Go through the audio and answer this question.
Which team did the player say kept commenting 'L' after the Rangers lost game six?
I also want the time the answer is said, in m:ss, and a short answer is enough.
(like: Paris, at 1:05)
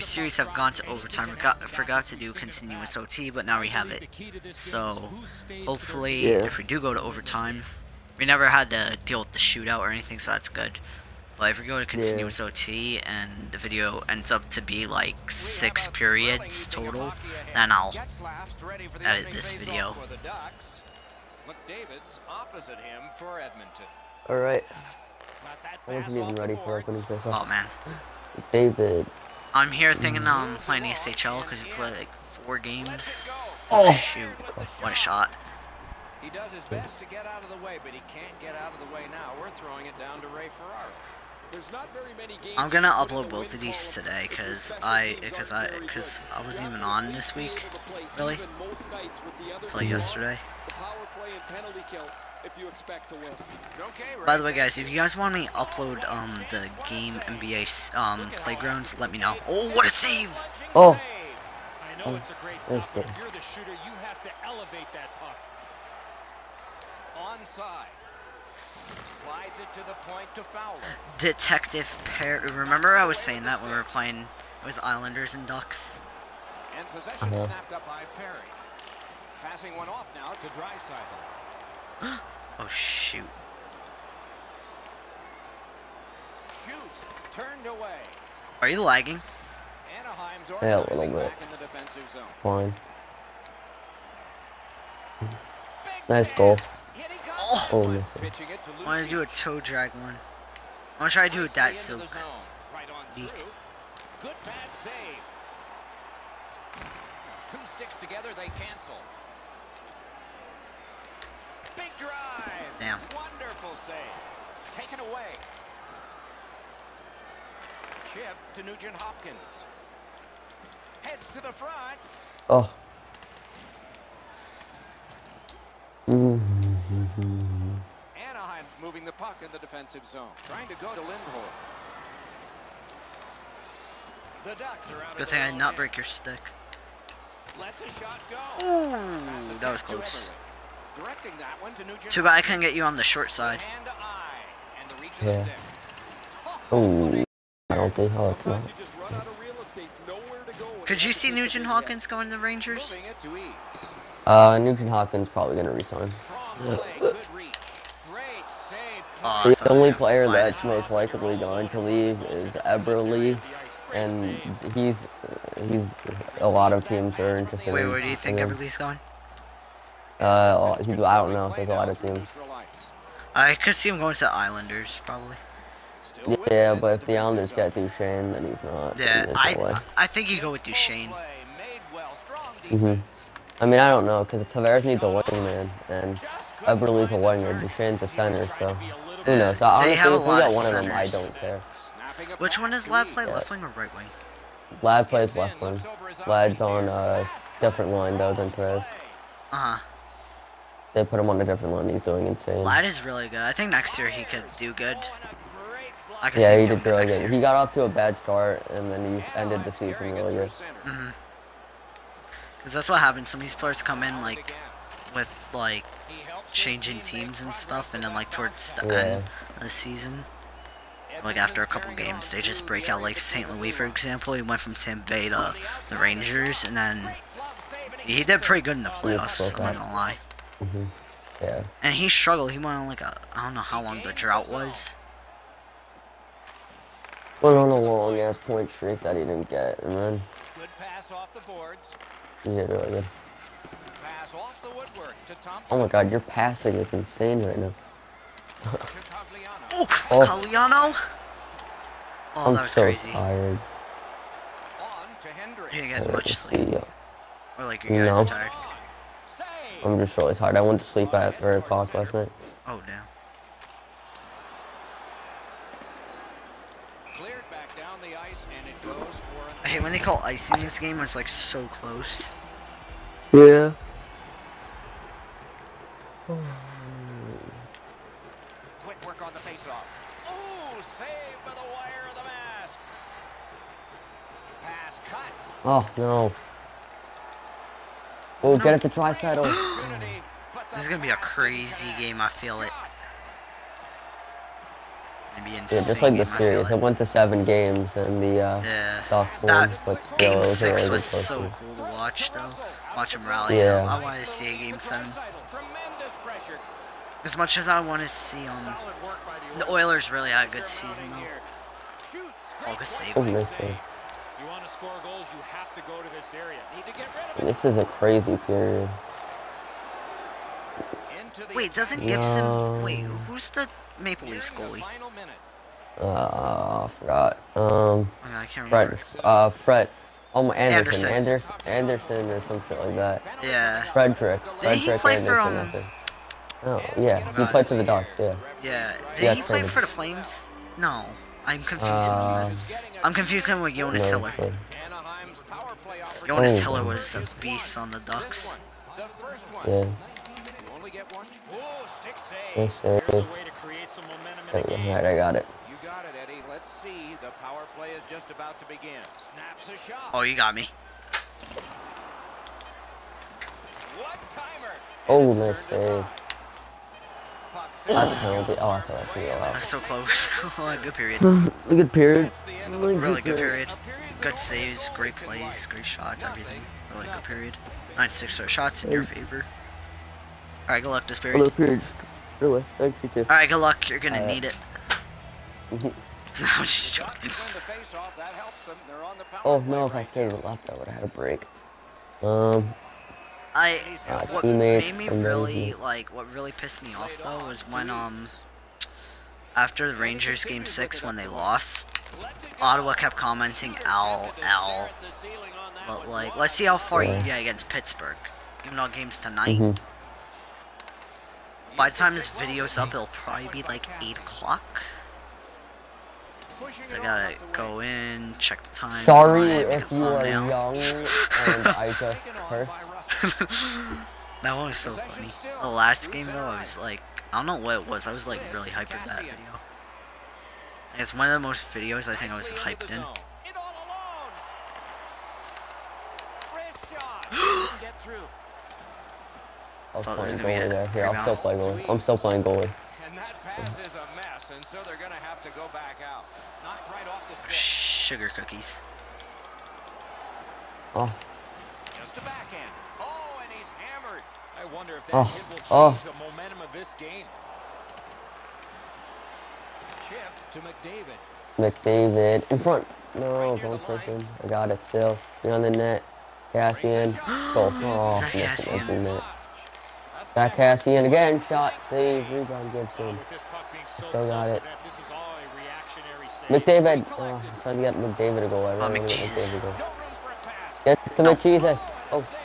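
Ottawa, at 6:42.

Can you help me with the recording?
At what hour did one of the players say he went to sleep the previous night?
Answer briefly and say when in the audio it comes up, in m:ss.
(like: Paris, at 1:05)
3 o'clock, at 4:21.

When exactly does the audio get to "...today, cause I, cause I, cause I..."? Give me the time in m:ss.
0:43.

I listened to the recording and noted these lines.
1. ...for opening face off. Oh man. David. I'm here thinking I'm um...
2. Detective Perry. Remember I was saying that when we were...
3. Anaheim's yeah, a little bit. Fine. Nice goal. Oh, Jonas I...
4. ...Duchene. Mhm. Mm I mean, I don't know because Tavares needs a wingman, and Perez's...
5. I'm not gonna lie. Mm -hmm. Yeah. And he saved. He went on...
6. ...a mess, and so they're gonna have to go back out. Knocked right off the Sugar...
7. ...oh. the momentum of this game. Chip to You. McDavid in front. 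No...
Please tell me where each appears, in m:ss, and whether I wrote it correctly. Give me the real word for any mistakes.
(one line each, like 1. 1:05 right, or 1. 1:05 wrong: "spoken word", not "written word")
1. 0:26 right
2. 1:11 right
3. 1:29 wrong: "Holy", not "Jonas"
4. 3:00 wrong: "Eberle", not "Perez"
5. 3:49 wrong: "struggled", not "saved"
6. 7:23 right
7. 7:36 wrong: "McDavid", not "You".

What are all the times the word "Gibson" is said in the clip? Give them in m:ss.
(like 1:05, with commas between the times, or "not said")
5:22, 7:52.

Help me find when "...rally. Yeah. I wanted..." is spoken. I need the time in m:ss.
5:03.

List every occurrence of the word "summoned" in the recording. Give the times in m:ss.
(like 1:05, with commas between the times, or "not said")
not said.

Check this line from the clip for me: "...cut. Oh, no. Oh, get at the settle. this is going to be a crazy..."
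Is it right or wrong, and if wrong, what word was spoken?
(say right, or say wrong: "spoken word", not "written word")
right.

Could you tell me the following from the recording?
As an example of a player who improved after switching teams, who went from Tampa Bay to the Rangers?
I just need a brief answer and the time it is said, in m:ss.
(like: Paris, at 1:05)
St. Louis, at 3:43.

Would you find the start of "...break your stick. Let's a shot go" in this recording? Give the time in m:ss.
2:15.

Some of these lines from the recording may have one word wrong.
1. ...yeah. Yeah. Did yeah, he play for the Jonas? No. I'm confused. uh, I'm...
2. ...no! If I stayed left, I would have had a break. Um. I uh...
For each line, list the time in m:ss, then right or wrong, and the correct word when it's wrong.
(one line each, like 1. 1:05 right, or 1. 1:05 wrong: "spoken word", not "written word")
1. 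5:38 wrong: "Flames", not "Jonas"
2. 6:29 right.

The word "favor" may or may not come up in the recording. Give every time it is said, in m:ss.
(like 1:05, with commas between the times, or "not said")
6:19.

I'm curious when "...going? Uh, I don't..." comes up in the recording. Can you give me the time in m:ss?
2:48.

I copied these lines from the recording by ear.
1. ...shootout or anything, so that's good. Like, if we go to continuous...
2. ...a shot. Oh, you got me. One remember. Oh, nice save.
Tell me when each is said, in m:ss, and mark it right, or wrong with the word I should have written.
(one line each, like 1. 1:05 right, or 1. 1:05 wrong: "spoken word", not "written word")
1. 0:09 right
2. 5:59 wrong: "timer", not "remember".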